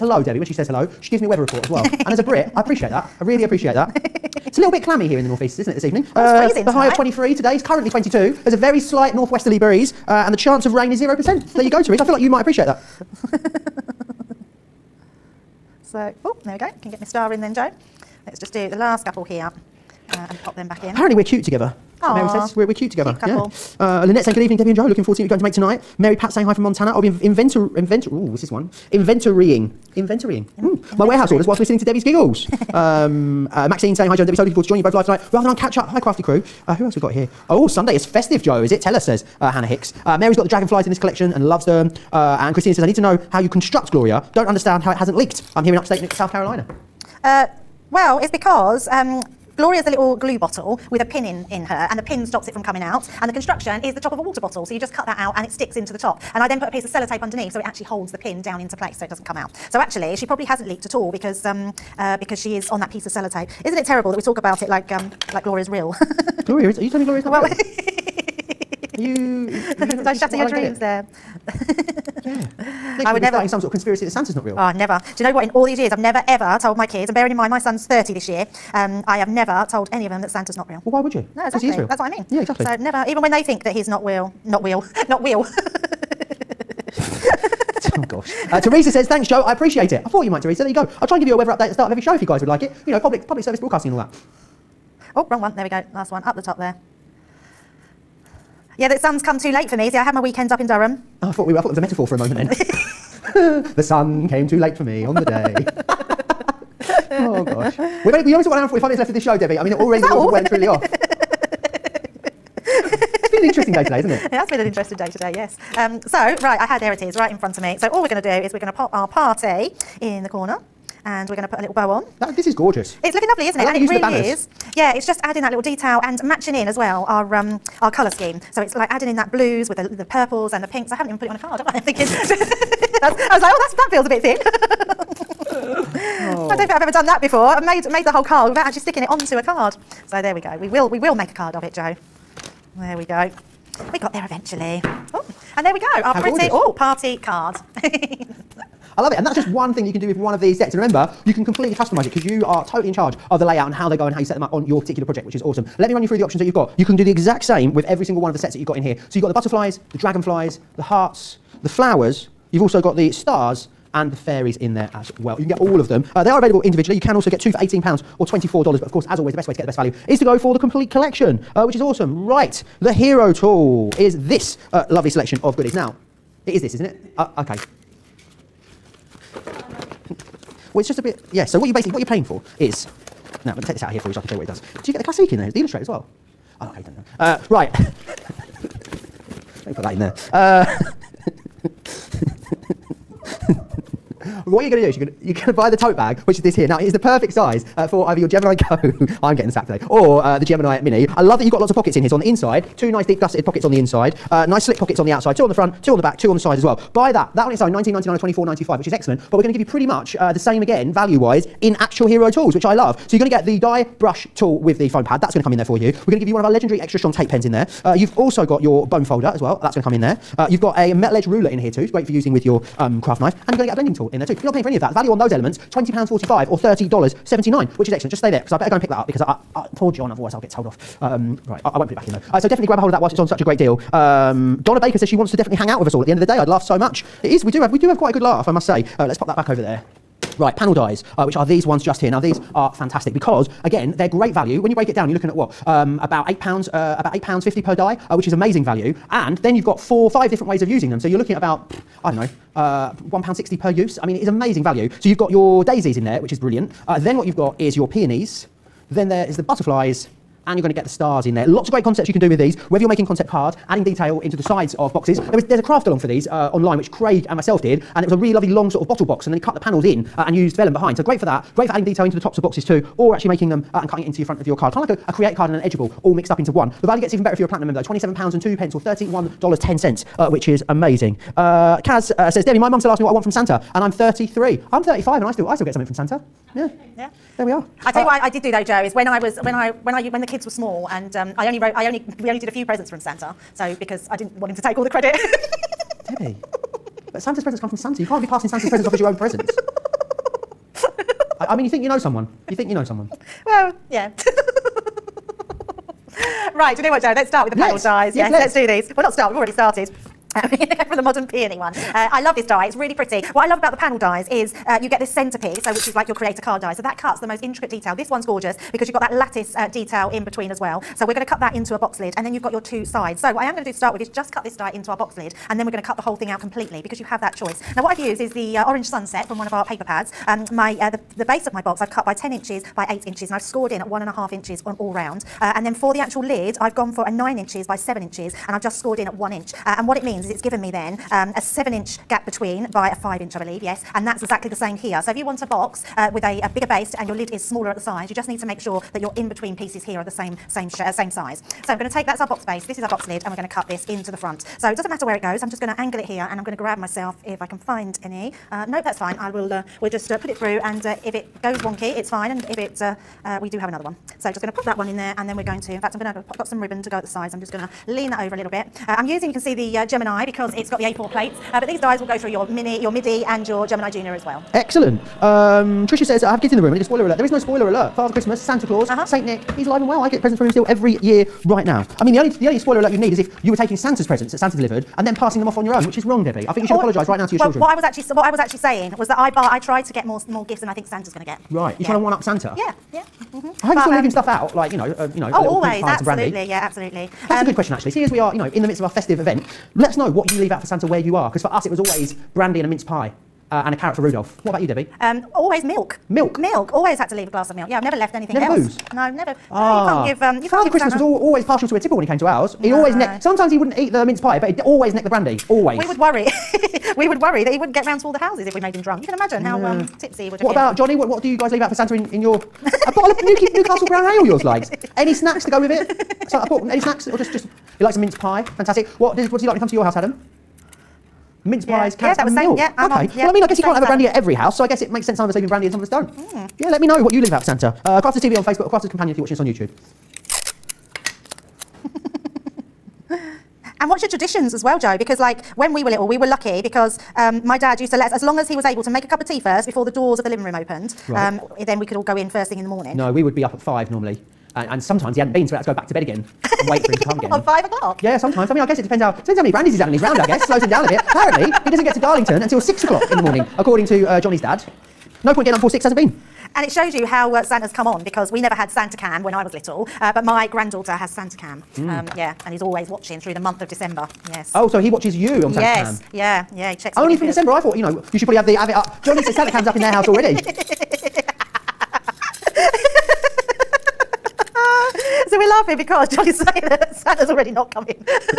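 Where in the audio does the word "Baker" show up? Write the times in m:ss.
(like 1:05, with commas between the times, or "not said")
3:54.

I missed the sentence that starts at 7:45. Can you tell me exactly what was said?
No point getting up before six hasn't been.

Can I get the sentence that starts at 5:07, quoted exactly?
Let's start with the panel yes.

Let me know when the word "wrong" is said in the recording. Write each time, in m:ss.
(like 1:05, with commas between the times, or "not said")
1:35, 6:26.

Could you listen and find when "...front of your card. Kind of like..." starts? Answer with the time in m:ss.
4:34.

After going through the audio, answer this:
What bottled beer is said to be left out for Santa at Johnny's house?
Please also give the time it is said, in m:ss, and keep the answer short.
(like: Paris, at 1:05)
Newcastle Brown Ale, at 7:03.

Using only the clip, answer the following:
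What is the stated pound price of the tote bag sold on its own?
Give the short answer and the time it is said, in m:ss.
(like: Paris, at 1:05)
19.99, at 3:27.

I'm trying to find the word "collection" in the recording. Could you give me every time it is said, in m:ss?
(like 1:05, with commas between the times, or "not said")
0:40, 2:50.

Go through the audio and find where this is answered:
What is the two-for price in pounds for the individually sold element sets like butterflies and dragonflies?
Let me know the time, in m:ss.
2:47.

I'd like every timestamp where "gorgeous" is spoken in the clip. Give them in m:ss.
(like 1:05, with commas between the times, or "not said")
2:02, 5:18.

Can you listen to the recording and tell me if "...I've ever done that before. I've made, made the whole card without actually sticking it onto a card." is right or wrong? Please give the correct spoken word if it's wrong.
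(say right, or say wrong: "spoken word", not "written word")
right.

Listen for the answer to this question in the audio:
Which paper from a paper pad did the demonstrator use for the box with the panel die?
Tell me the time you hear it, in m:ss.
5:28.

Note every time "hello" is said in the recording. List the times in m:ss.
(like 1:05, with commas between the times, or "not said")
0:00.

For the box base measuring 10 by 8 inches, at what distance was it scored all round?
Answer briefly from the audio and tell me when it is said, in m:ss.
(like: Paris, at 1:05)
1.5 inches, at 5:33.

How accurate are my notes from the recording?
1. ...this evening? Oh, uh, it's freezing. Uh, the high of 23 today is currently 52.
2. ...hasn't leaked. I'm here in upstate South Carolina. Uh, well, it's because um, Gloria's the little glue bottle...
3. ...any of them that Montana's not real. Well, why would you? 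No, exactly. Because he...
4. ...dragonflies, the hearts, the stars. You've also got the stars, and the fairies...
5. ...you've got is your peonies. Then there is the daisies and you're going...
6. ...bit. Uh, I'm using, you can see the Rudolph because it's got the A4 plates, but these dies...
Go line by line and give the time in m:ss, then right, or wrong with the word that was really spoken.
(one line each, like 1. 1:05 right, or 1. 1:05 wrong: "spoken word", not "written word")
1. 0:05 wrong: "22", not "52"
2. 0:44 right
3. 1:19 wrong: "Santa", not "Montana"
4. 2:39 wrong: "flowers", not "stars"
5. 4:17 wrong: "butterflies", not "daisies"
6. 6:08 wrong: "Gemini", not "Rudolph".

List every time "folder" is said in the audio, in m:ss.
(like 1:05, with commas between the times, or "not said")
3:39.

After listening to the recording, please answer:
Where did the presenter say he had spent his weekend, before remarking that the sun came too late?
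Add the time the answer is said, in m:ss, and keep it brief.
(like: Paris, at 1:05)
Durham, at 1:40.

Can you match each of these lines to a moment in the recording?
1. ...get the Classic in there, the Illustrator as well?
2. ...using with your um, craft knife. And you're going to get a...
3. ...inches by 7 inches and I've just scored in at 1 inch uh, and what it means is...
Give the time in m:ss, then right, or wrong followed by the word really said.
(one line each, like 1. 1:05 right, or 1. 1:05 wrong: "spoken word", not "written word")
1. 3:04 right
2. 3:42 right
3. 5:37 right.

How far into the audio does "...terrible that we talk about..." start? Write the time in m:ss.
1:03.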